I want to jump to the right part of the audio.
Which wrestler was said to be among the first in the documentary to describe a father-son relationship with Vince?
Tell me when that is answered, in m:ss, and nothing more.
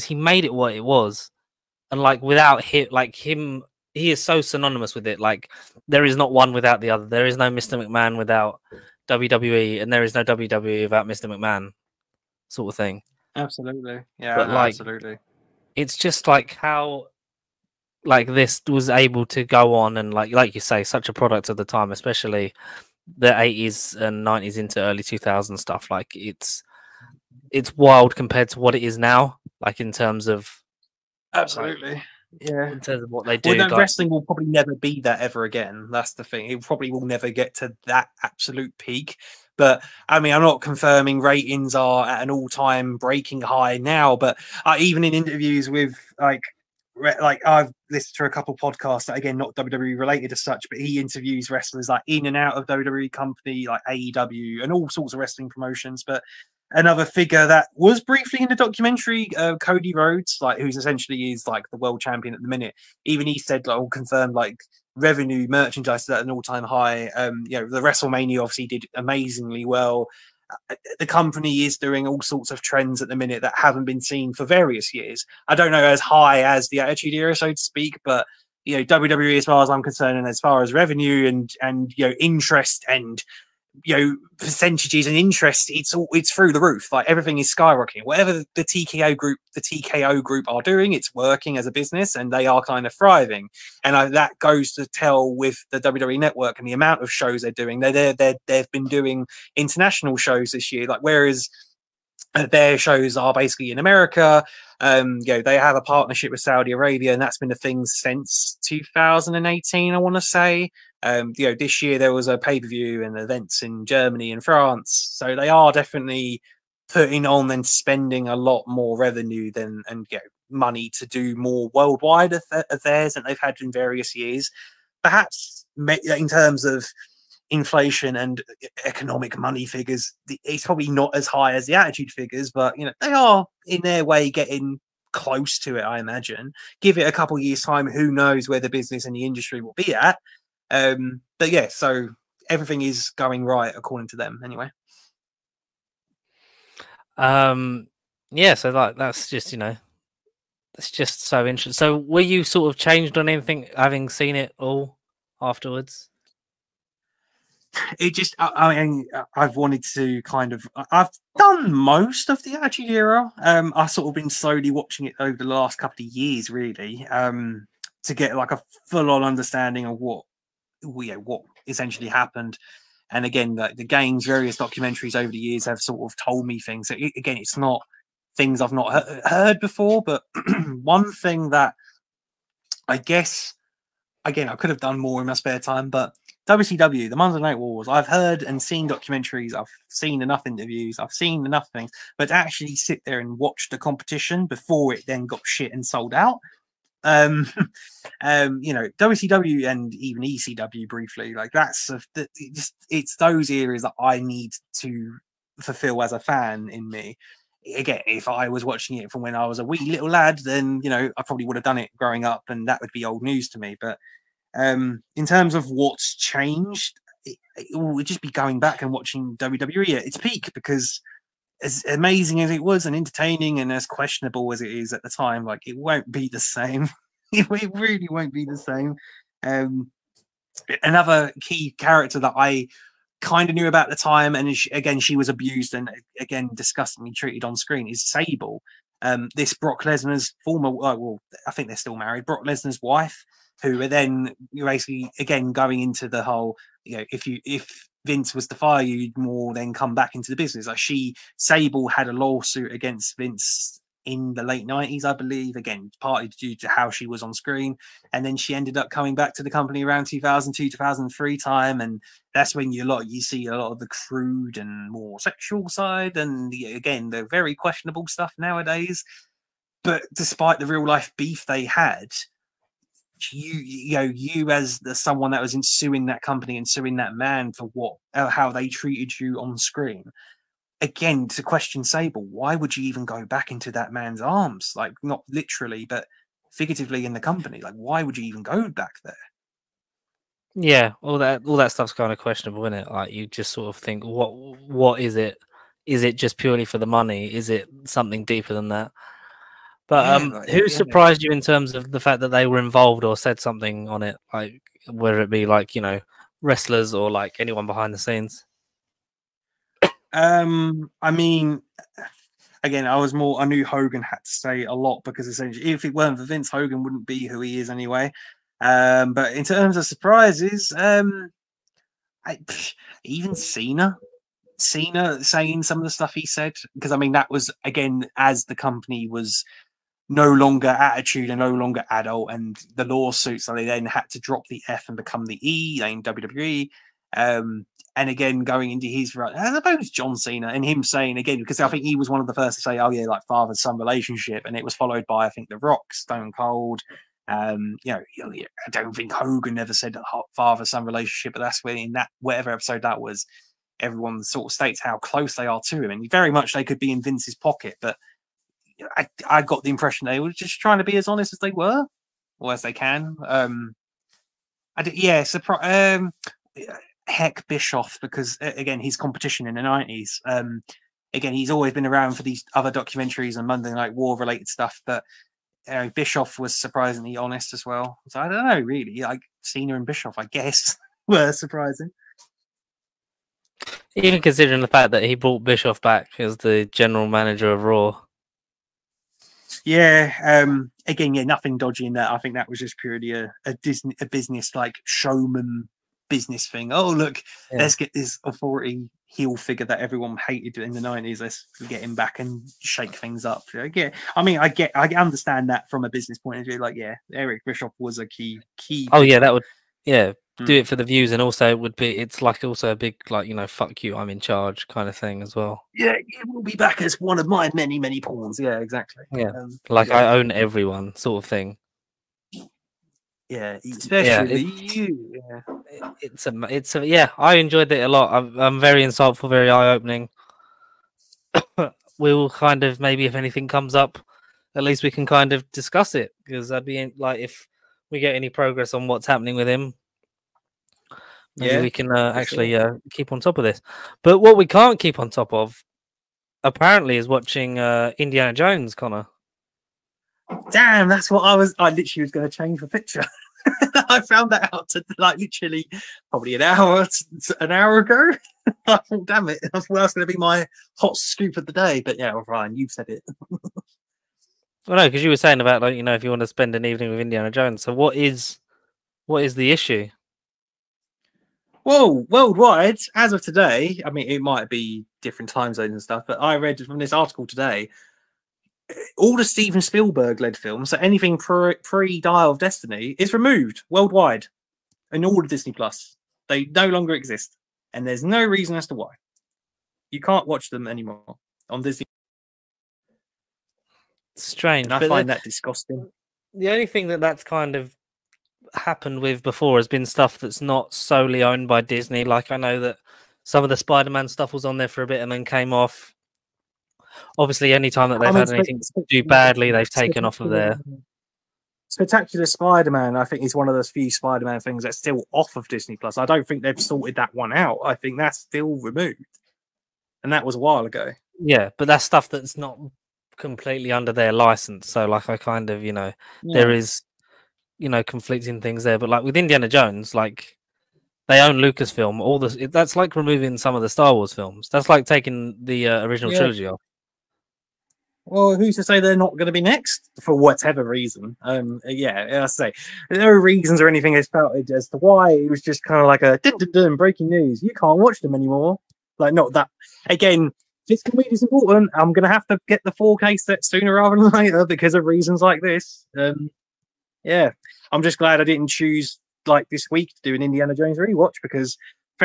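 5:39.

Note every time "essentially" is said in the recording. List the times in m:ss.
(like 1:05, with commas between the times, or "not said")
1:00, 2:51, 5:15.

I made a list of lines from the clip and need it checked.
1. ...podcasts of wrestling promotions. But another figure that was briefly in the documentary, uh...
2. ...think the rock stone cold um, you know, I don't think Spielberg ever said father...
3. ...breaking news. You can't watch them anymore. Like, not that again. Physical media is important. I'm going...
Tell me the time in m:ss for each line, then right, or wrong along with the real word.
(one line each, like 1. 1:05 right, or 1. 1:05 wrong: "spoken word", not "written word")
1. 0:54 wrong: "sorts", not "podcasts"
2. 5:45 wrong: "Hogan", not "Spielberg"
3. 9:06 right.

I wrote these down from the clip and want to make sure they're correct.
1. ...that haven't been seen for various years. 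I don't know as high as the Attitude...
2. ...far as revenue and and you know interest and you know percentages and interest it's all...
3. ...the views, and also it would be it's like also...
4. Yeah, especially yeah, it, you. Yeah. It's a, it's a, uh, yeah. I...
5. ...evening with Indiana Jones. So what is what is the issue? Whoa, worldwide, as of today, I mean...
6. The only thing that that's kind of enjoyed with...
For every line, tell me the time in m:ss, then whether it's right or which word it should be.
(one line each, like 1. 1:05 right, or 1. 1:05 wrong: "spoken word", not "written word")
1. 1:13 right
2. 1:20 right
3. 6:50 right
4. 7:03 right
5. 7:46 right
6. 8:16 wrong: "happened", not "enjoyed".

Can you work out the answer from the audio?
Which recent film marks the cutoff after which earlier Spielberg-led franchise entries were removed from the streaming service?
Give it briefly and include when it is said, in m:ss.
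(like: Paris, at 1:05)
Dial of Destiny, at 8:01.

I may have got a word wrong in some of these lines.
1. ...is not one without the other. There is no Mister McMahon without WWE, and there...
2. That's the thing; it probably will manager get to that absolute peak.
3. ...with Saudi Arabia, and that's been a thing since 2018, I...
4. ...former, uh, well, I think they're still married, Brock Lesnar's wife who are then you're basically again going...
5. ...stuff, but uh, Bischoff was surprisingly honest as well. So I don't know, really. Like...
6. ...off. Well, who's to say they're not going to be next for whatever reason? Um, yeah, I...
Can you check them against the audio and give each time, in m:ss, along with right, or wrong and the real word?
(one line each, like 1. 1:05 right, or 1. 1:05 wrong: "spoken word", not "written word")
1. 0:06 right
2. 0:35 wrong: "never", not "manager"
3. 1:46 right
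4. 4:00 right
5. 6:14 right
6. 8:56 right.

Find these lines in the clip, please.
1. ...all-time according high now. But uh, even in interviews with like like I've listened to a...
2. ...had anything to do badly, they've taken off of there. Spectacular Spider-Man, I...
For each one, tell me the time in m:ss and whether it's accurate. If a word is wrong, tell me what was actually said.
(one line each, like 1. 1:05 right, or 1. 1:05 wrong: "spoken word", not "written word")
1. 0:42 wrong: "breaking", not "according"
2. 8:28 right.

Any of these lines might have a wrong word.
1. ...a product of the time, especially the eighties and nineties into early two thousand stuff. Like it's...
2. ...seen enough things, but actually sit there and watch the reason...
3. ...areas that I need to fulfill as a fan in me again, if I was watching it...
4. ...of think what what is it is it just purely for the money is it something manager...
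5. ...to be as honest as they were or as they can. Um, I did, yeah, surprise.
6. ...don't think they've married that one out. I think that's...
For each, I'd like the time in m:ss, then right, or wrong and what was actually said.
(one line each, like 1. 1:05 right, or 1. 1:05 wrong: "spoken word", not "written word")
1. 0:21 right
2. 3:11 wrong: "competition", not "reason"
3. 3:23 right
4. 4:53 wrong: "deeper", not "manager"
5. 6:00 right
6. 8:36 wrong: "sorted", not "married".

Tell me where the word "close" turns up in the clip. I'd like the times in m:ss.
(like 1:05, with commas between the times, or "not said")
2:15, 5:54.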